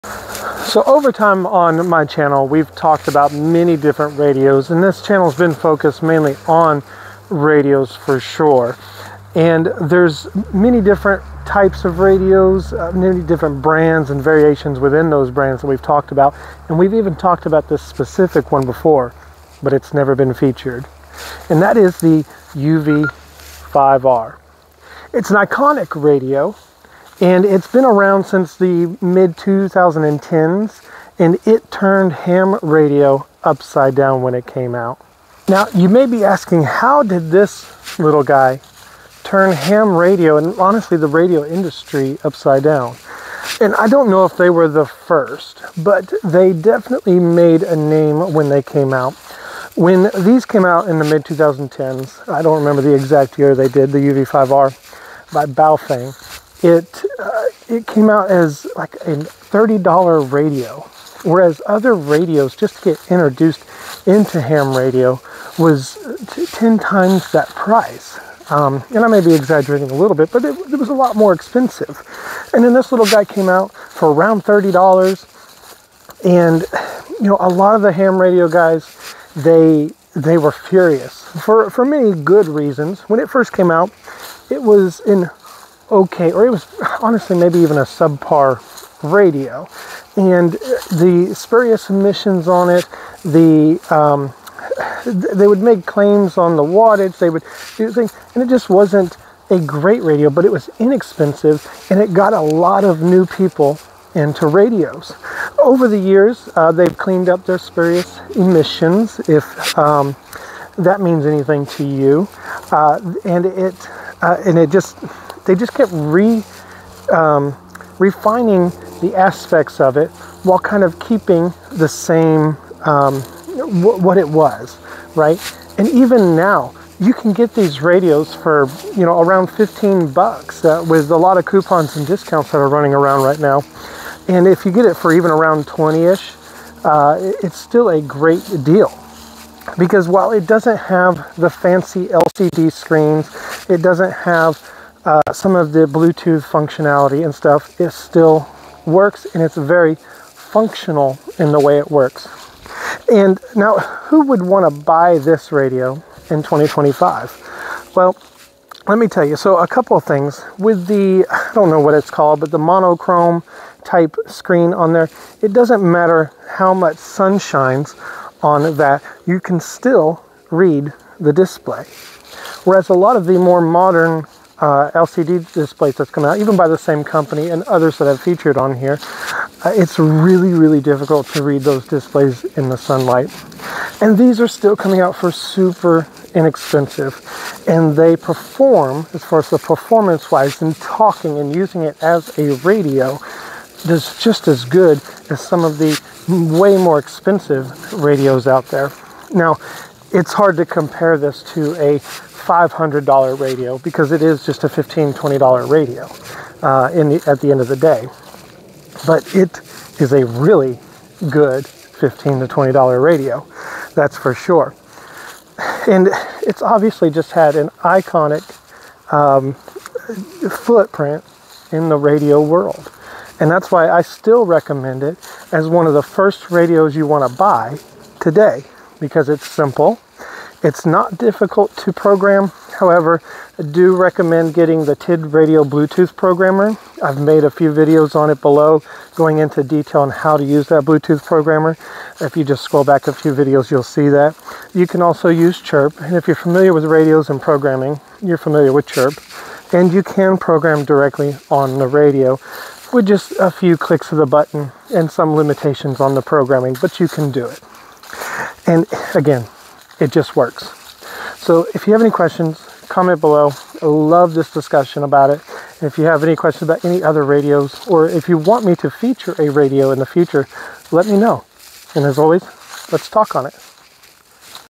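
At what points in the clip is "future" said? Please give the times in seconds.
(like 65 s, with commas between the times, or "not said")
270 s.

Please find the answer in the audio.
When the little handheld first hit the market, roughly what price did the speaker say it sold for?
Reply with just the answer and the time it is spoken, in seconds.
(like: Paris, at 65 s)
$30, at 59 s.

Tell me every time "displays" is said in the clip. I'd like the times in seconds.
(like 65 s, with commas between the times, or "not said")
171 s, 175 s, 181 s.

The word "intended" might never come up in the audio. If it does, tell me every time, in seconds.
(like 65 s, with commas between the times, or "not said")
not said.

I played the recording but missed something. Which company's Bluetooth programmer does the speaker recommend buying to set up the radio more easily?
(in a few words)
TID Radio.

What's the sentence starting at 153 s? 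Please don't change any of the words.
And now, who would want to buy this radio in 2025?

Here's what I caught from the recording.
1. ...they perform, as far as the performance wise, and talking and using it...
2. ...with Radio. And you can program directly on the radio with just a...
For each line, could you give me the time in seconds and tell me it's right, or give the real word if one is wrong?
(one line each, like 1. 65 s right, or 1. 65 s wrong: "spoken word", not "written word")
1. 187 s right
2. 248 s wrong: "Chirp", not "Radio".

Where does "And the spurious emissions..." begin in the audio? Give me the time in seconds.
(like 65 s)
90 s.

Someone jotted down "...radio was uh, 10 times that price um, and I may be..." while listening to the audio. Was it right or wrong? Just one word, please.
right.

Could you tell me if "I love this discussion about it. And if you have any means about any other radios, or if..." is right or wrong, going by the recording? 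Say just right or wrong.
wrong.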